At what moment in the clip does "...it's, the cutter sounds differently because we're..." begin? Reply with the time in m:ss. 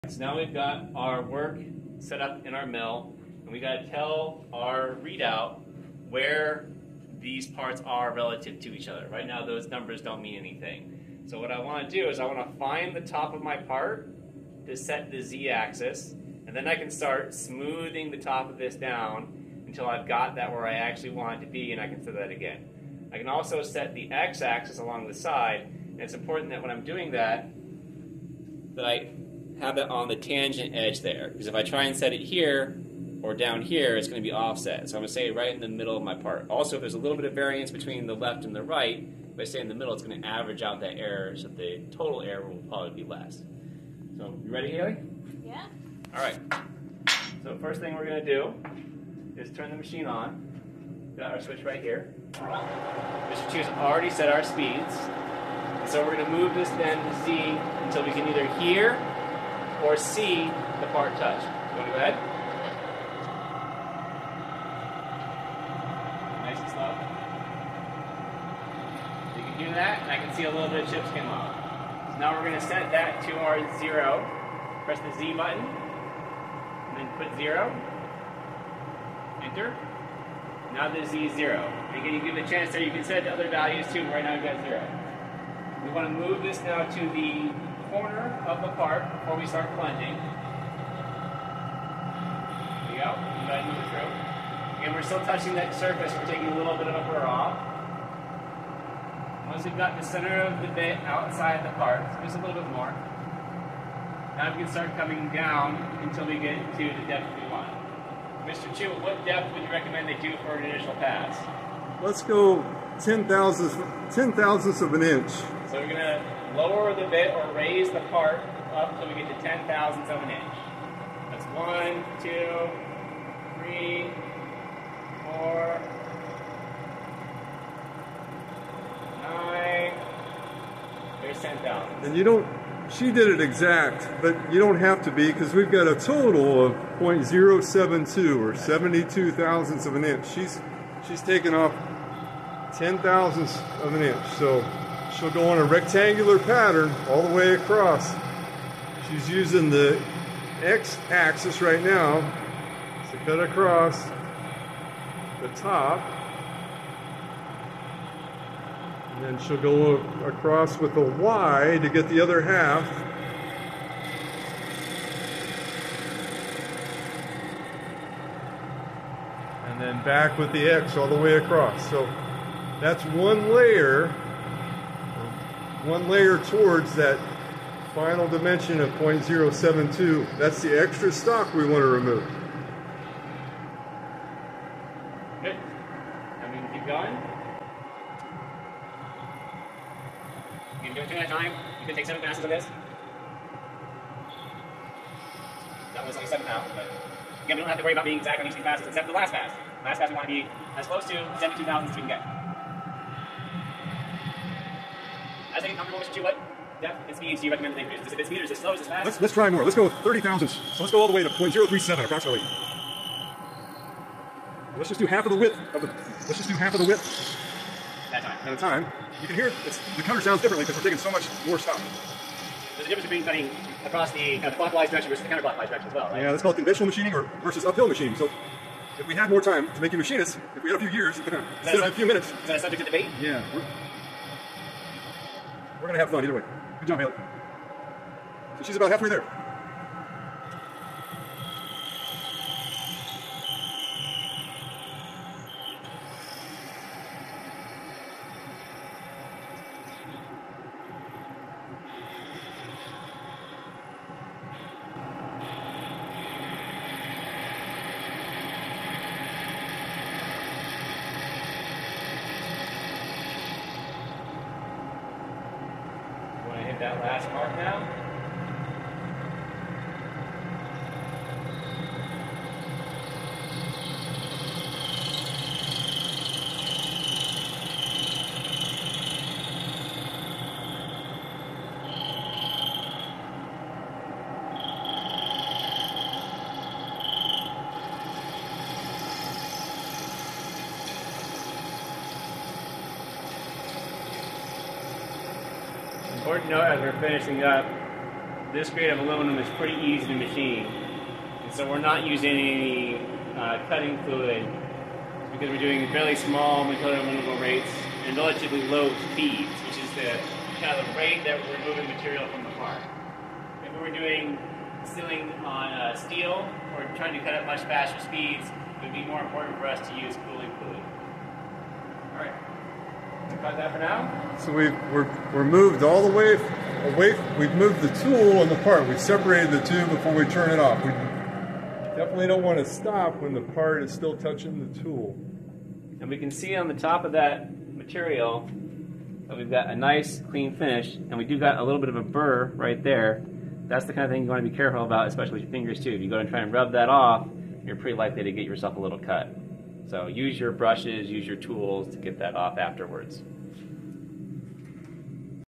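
3:39.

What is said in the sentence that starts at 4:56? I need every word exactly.
important note as we're finishing up, this grade of aluminum is pretty easy to machine.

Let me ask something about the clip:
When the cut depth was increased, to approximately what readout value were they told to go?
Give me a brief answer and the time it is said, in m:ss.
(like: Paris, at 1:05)
0.037, at 3:31.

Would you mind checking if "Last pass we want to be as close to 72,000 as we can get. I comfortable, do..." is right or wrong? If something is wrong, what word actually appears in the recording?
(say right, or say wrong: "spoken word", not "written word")
right.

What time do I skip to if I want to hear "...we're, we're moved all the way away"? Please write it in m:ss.
5:24.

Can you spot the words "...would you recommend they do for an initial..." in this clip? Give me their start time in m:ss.
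1:49.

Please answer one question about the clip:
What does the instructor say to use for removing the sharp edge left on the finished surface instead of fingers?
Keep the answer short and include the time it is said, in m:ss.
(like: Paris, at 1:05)
brushes, at 5:50.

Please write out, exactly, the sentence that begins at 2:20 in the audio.
She's, she's taken off 10 thousandths of an inch.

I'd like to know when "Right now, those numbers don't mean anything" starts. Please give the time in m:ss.
0:09.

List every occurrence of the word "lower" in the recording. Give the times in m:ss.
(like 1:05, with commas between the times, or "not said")
1:56.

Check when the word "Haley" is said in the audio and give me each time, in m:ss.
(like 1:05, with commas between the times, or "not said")
0:44, 3:56.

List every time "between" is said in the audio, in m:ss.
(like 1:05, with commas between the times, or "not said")
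0:37, 3:43.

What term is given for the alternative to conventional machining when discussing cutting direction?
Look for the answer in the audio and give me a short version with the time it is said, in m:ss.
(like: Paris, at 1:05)
uphill machining, at 3:47.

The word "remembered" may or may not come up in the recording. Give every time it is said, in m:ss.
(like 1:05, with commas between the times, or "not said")
not said.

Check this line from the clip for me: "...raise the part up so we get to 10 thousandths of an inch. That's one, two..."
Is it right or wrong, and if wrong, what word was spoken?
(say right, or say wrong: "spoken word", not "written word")
right.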